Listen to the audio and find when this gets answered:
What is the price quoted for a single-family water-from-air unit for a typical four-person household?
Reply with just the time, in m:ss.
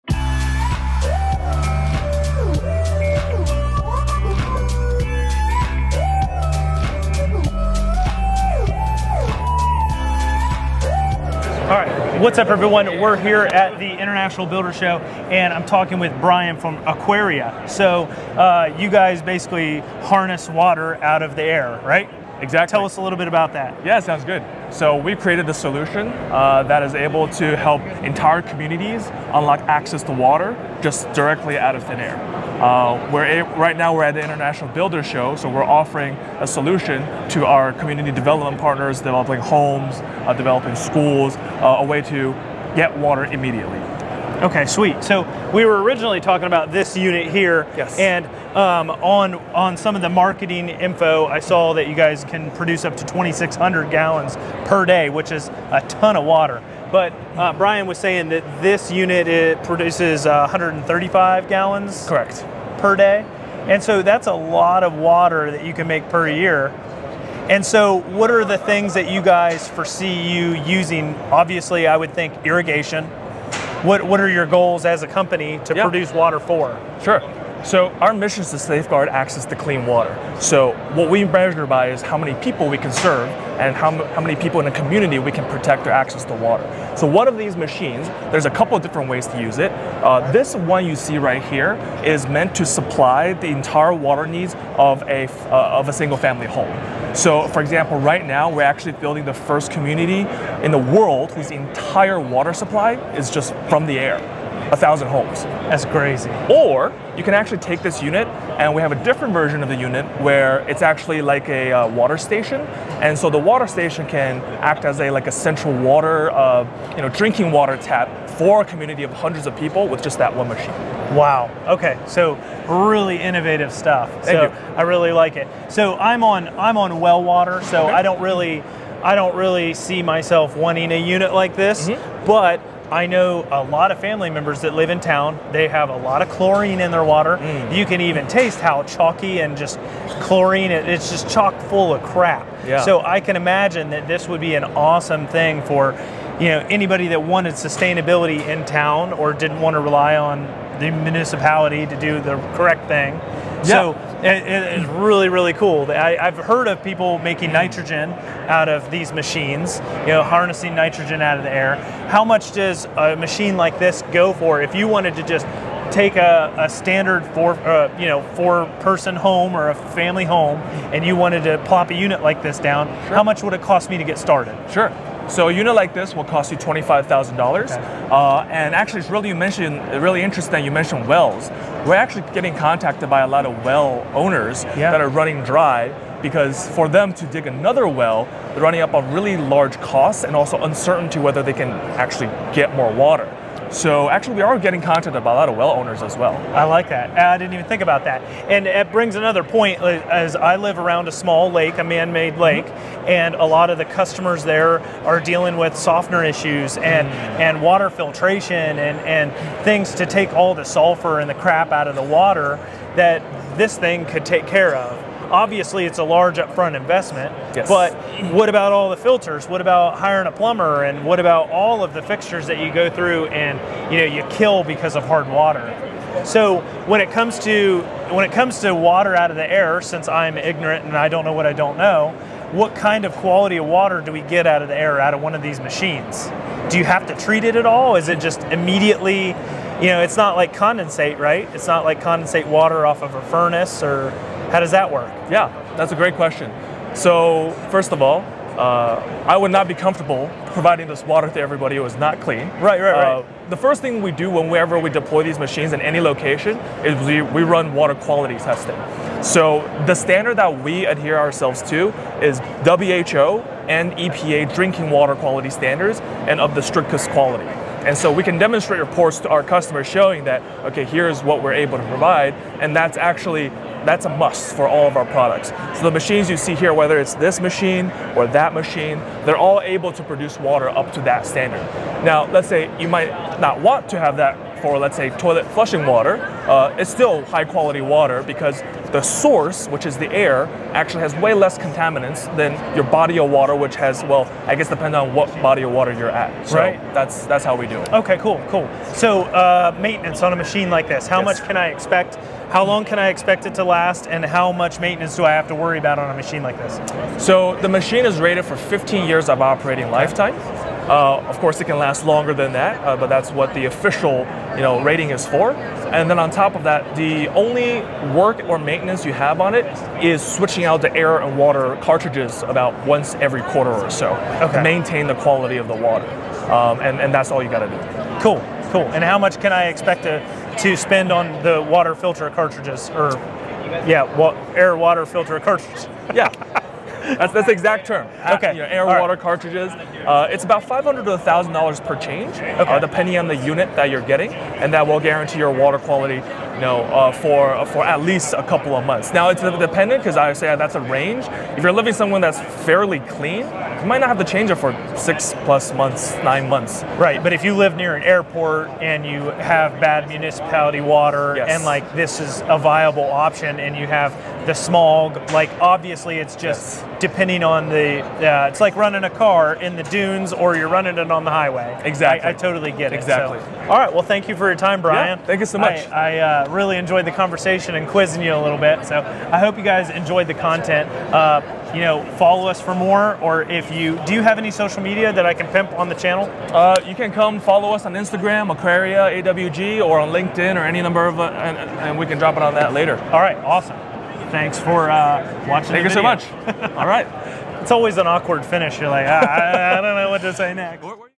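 2:56.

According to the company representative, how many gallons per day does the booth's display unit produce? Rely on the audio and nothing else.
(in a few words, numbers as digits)
135.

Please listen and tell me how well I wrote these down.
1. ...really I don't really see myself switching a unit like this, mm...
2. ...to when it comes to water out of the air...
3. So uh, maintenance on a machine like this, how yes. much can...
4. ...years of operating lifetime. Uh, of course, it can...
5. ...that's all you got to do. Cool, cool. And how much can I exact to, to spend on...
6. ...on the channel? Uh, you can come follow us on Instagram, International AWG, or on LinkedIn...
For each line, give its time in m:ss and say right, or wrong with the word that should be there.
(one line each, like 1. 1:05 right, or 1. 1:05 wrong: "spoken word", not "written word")
1. 2:08 wrong: "wanting", not "switching"
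2. 3:47 right
3. 4:58 right
4. 5:09 right
5. 5:27 wrong: "expect", not "exact"
6. 6:25 wrong: "Aquaria", not "International".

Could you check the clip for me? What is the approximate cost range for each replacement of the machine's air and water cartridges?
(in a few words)
$500 to $1,000.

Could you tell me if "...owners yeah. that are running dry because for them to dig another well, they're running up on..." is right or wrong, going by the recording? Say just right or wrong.
right.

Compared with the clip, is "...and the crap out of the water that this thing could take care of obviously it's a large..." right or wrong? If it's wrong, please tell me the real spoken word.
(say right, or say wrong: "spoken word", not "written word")
right.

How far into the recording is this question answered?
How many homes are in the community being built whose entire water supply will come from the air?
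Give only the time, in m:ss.
1:44.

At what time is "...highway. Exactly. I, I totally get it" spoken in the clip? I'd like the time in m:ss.
6:11.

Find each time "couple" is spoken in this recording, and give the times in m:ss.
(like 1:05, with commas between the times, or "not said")
1:28, 5:48.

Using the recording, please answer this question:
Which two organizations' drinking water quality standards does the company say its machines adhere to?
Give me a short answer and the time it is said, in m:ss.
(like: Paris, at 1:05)
WHO and EPA, at 4:22.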